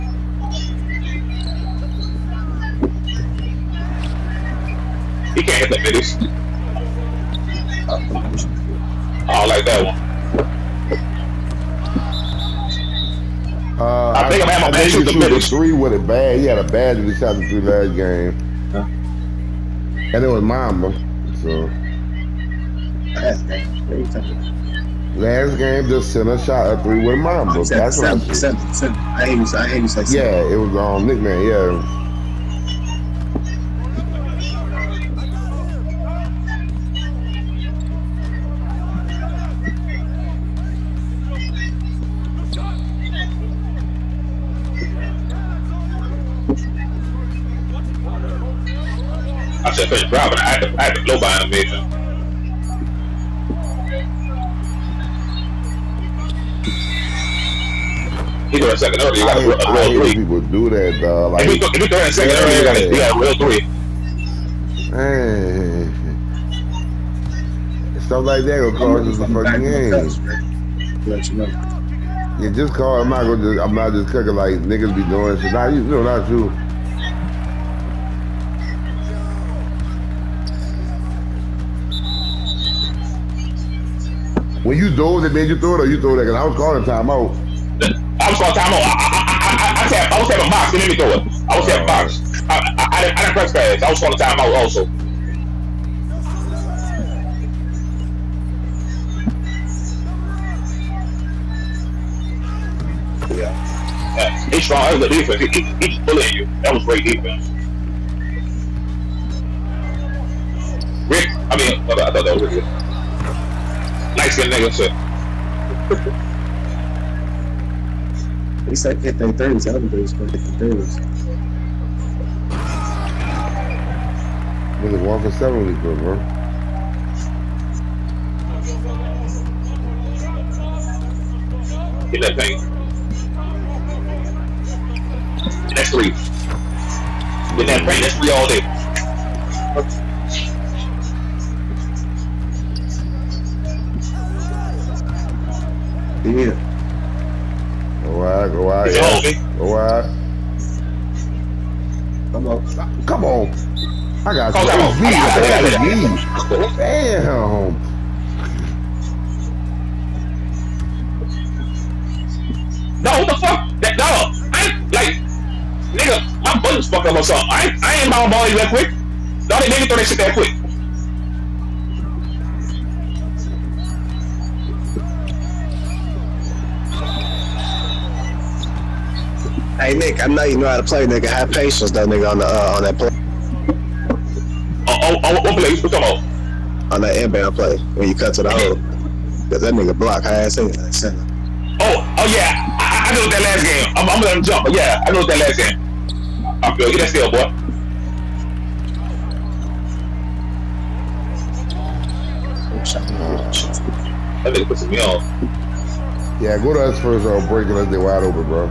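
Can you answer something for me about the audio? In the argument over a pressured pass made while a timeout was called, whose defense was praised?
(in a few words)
Rick.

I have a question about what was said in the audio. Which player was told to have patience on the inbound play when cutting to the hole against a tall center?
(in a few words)
Nick.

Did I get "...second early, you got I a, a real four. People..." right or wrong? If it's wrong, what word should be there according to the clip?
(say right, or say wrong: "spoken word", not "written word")
wrong: "three", not "four".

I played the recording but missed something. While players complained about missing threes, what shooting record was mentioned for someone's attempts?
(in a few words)
1 for 7.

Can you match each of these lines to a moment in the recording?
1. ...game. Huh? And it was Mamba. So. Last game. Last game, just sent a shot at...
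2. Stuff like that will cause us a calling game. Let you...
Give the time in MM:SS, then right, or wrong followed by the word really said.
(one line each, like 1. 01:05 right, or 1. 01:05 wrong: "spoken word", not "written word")
1. 00:17 right
2. 01:07 wrong: "fucking", not "calling".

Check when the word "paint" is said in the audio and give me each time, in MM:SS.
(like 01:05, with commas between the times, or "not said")
02:12, 02:17.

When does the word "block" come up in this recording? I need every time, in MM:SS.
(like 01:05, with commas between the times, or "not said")
03:09.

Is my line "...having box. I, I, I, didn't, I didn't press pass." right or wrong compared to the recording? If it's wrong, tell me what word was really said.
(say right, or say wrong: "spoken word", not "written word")
right.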